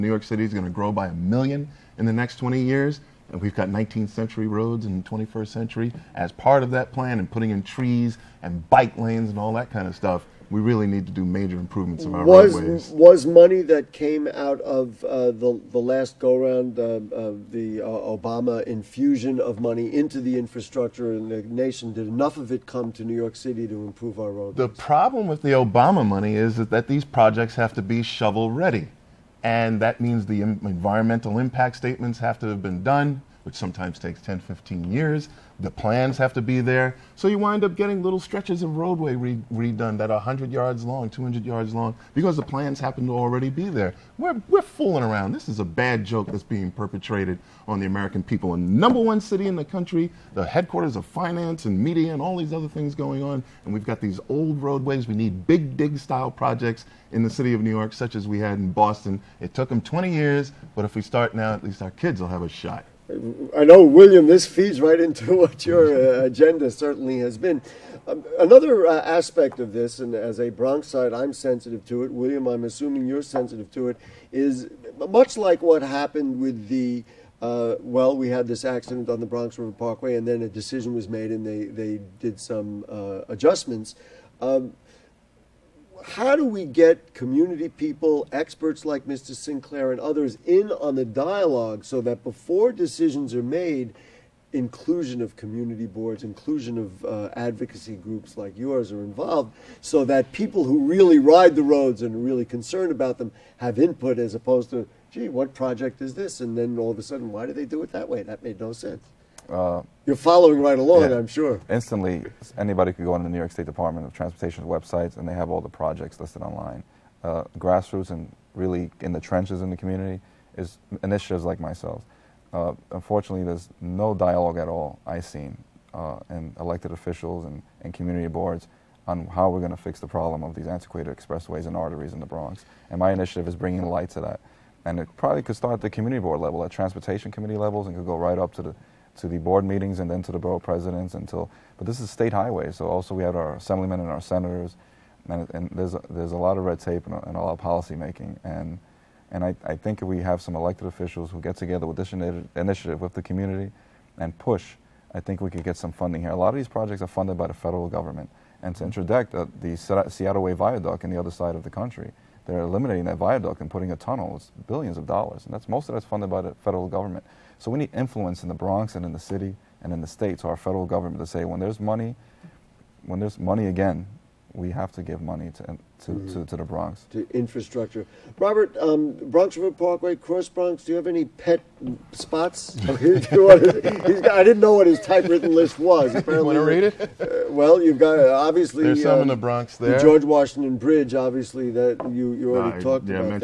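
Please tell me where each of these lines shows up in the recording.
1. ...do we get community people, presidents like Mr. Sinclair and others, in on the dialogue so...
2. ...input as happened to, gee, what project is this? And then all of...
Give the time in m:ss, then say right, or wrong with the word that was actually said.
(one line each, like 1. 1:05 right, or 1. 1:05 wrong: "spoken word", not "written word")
1. 1:26 wrong: "experts", not "presidents"
2. 1:43 wrong: "opposed", not "happened".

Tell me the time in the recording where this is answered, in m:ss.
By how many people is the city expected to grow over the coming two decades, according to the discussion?
0:01.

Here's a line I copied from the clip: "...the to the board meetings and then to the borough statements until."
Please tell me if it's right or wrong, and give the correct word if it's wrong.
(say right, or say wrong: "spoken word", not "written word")
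wrong: "presidents", not "statements".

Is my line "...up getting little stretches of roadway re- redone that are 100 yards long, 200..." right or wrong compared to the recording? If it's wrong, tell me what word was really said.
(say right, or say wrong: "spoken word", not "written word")
right.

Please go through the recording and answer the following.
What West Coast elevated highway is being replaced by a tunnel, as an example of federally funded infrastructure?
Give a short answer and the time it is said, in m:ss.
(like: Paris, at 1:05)
Seattle Way Viaduct, at 2:40.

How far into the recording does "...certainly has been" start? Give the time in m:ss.
1:06.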